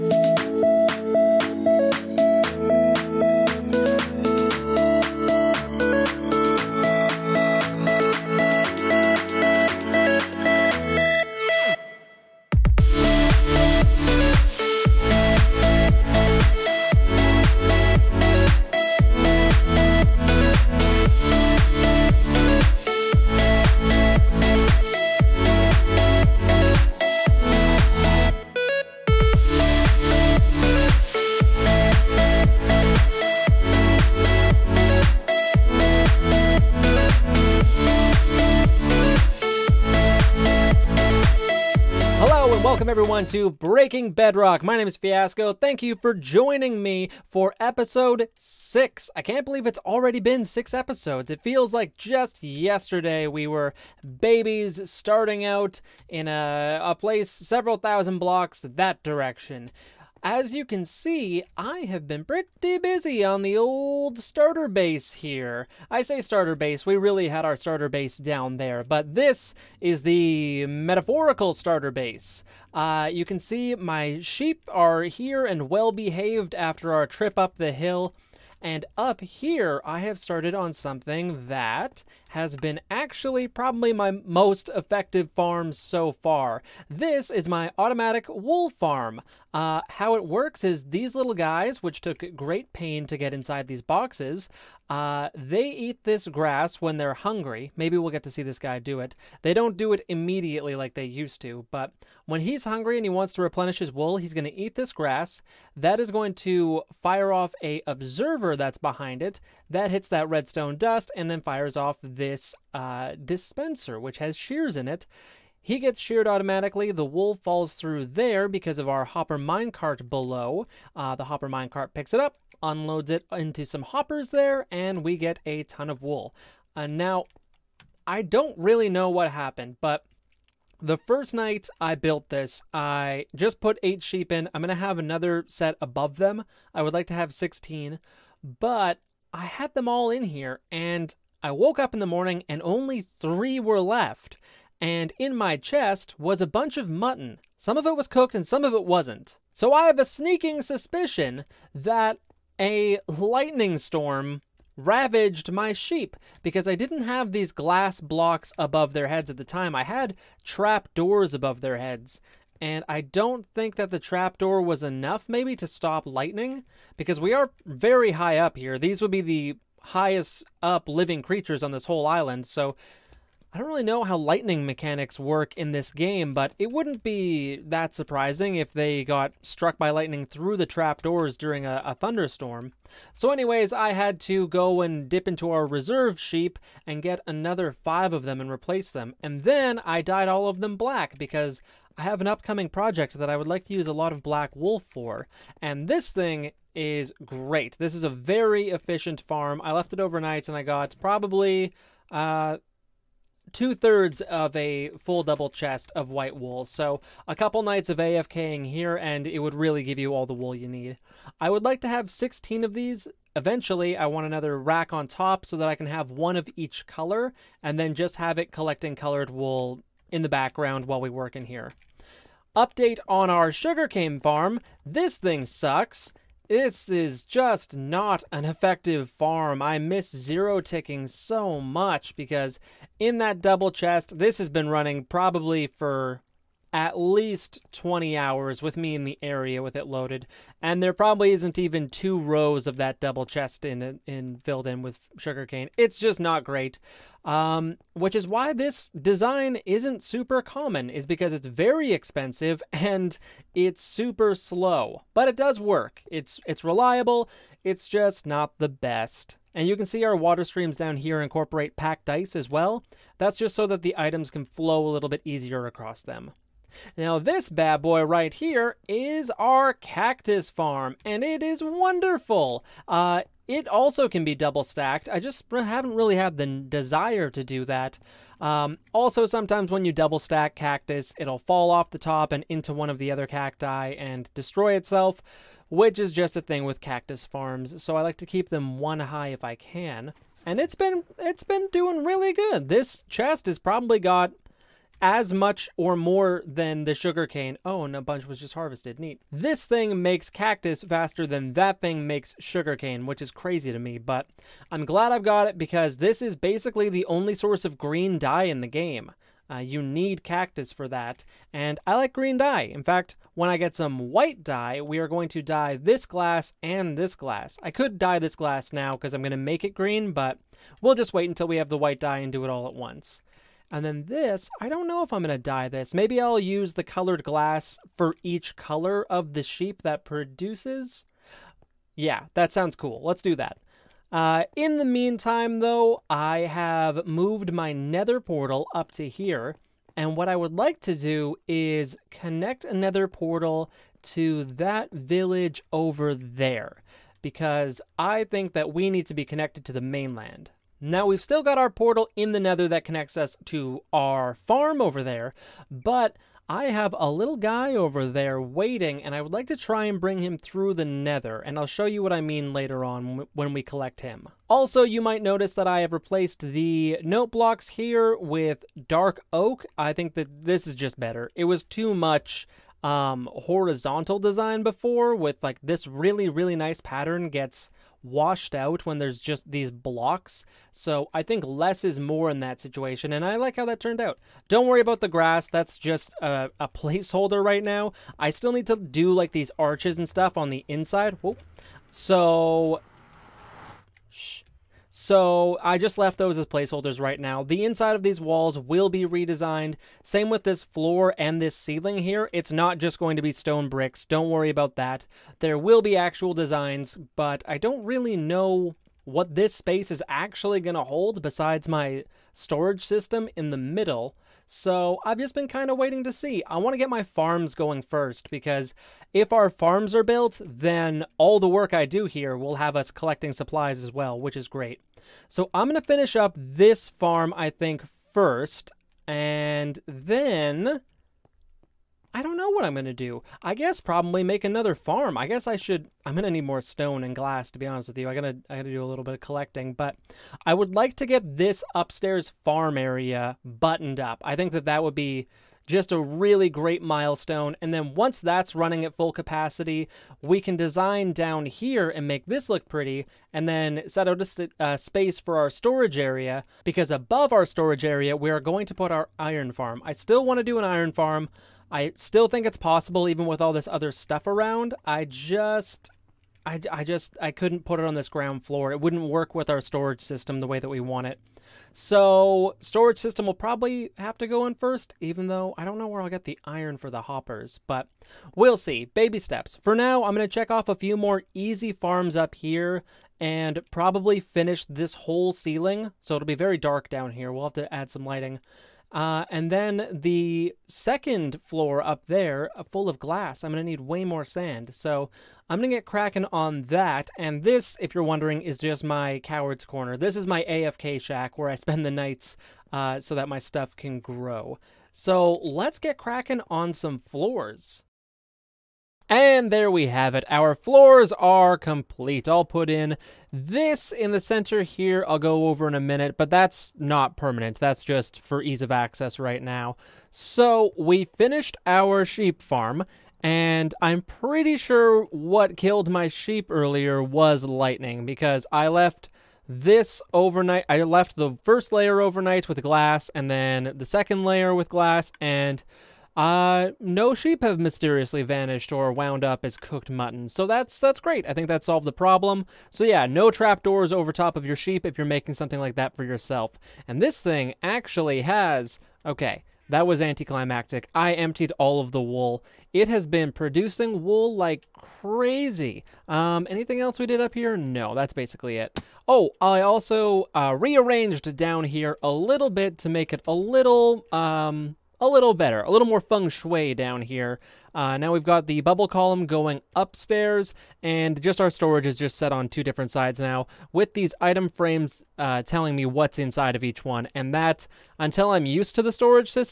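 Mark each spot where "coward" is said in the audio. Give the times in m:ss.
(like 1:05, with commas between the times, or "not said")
8:19.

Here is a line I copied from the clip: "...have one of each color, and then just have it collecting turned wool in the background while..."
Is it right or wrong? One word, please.
wrong.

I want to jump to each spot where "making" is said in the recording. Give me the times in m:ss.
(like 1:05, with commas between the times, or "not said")
9:05.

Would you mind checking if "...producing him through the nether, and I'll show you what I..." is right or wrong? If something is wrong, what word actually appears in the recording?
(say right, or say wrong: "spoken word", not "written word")
wrong: "bring", not "producing".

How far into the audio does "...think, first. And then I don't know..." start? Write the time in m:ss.
7:07.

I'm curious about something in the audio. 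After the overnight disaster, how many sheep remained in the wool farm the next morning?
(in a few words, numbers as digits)
3.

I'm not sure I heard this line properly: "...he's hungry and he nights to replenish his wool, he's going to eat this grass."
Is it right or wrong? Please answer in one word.
wrong.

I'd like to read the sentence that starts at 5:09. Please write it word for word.
Uh, you need cactus for that, and I like green dye.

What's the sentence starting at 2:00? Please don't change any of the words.
Uh, the hopper minecart picks it up, unloads it into some hoppers there, and we get a ton of wool.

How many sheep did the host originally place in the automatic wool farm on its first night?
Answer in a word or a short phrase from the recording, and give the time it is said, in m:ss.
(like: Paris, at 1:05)
8, at 2:13.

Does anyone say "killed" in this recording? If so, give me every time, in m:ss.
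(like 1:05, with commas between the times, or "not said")
8:45.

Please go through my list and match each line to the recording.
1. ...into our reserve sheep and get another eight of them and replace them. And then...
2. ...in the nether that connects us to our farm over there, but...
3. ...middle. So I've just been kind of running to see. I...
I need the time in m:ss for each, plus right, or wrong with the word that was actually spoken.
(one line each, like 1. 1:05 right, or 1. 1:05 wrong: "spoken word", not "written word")
1. 3:05 wrong: "five", not "eight"
2. 5:52 right
3. 6:53 wrong: "waiting", not "running".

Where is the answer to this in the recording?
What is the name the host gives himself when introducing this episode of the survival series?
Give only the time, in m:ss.
0:44.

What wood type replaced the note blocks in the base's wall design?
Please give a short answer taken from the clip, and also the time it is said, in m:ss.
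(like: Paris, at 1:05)
dark oak, at 6:08.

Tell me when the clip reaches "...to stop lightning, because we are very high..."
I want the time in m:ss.
2:45.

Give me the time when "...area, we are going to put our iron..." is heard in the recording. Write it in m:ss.
7:37.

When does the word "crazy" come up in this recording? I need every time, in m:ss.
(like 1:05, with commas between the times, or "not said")
5:03, 9:14.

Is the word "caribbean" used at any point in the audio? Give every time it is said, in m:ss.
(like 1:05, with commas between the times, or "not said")
not said.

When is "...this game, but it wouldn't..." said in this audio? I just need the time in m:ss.
2:55.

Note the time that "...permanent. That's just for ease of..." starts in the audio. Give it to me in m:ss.
8:37.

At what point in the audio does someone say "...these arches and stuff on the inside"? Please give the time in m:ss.
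6:29.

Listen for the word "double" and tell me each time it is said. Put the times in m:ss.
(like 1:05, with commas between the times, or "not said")
3:25, 3:53, 4:03, 4:34, 4:39.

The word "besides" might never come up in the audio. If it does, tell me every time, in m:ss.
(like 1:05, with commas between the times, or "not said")
6:51.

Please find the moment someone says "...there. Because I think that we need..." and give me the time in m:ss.
5:46.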